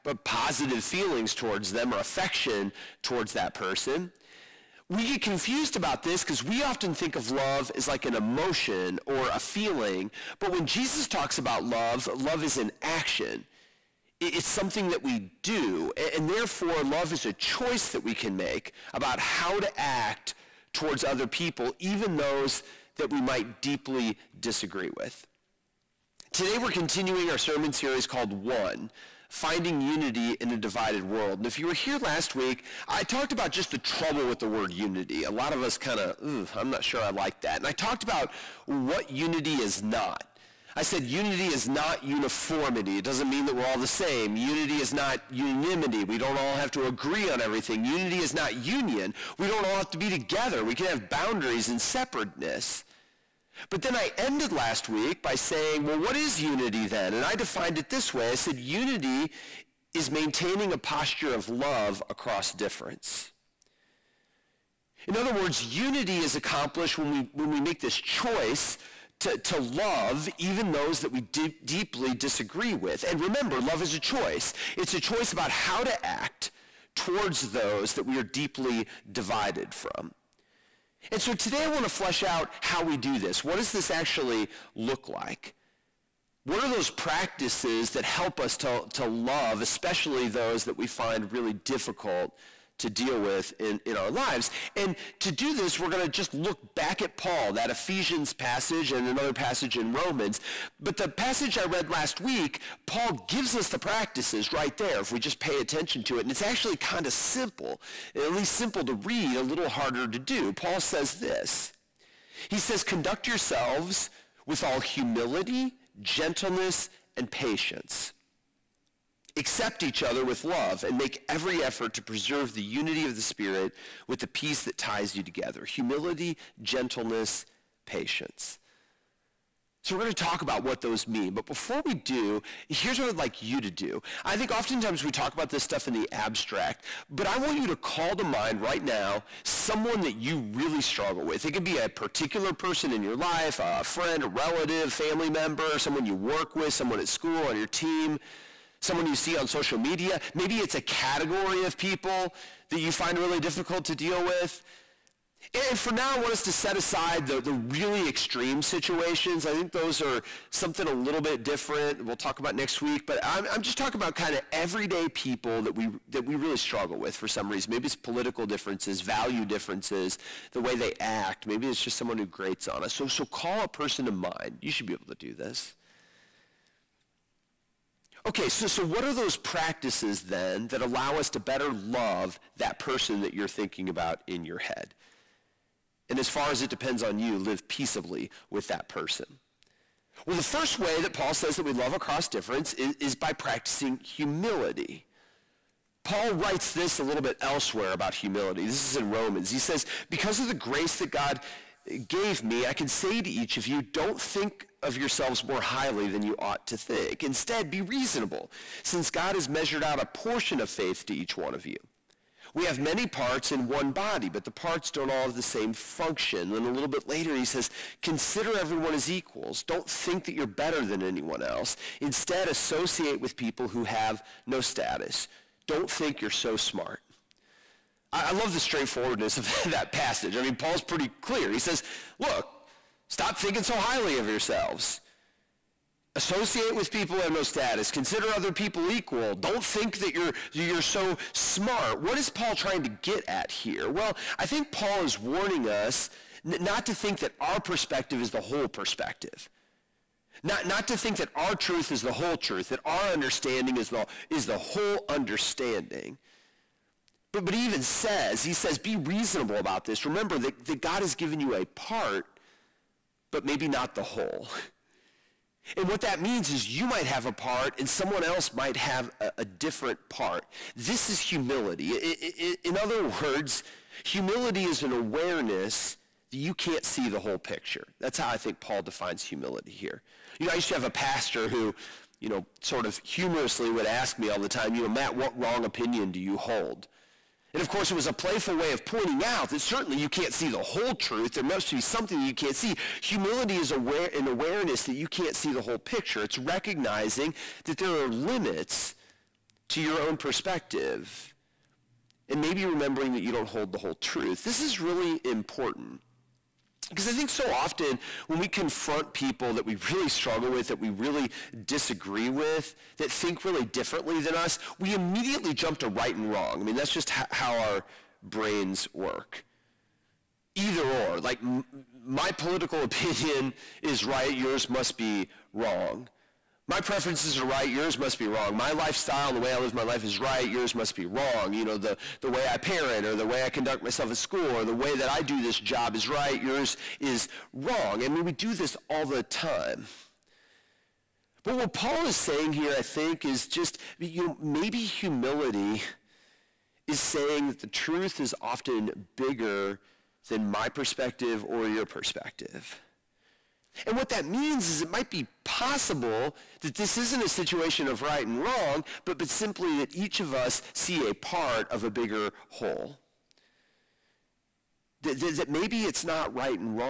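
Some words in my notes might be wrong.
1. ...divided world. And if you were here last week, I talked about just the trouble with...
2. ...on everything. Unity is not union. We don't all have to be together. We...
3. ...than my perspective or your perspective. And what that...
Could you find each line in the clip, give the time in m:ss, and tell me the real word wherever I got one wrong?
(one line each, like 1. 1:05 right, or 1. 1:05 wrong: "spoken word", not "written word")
1. 0:30 right
2. 0:47 right
3. 5:50 right.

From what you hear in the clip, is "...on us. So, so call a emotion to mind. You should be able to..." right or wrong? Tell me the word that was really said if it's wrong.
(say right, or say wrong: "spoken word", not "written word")
wrong: "person", not "emotion".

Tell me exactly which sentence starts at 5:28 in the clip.
My lifestyle and the way I live my life is right, yours must be wrong.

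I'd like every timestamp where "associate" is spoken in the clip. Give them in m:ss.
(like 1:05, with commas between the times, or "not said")
3:42, 3:56.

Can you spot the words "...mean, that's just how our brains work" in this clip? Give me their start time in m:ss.
5:16.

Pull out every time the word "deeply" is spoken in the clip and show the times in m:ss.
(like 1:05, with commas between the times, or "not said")
0:23, 1:11, 1:18.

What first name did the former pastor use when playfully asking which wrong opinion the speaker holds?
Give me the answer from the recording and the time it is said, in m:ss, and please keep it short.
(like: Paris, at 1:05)
Matt, at 4:44.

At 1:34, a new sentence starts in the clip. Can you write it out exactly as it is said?
And to do this, we're going to just look back at Paul, that Ephesians passage and another passage in Romans.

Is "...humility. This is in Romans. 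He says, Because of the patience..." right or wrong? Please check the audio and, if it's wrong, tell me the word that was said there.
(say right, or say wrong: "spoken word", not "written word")
wrong: "grace", not "patience".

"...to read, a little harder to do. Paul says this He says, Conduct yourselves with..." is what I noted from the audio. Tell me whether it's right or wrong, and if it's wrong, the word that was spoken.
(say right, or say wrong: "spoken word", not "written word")
right.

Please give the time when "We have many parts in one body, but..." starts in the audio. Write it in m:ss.
3:32.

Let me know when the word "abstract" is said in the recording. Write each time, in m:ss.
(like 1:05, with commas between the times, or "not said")
2:16.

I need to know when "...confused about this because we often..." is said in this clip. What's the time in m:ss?
0:05.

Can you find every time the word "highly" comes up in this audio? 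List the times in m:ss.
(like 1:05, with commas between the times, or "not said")
3:25, 3:53.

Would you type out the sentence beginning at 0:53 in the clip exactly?
But then I ended last week by saying, well, what is unity then?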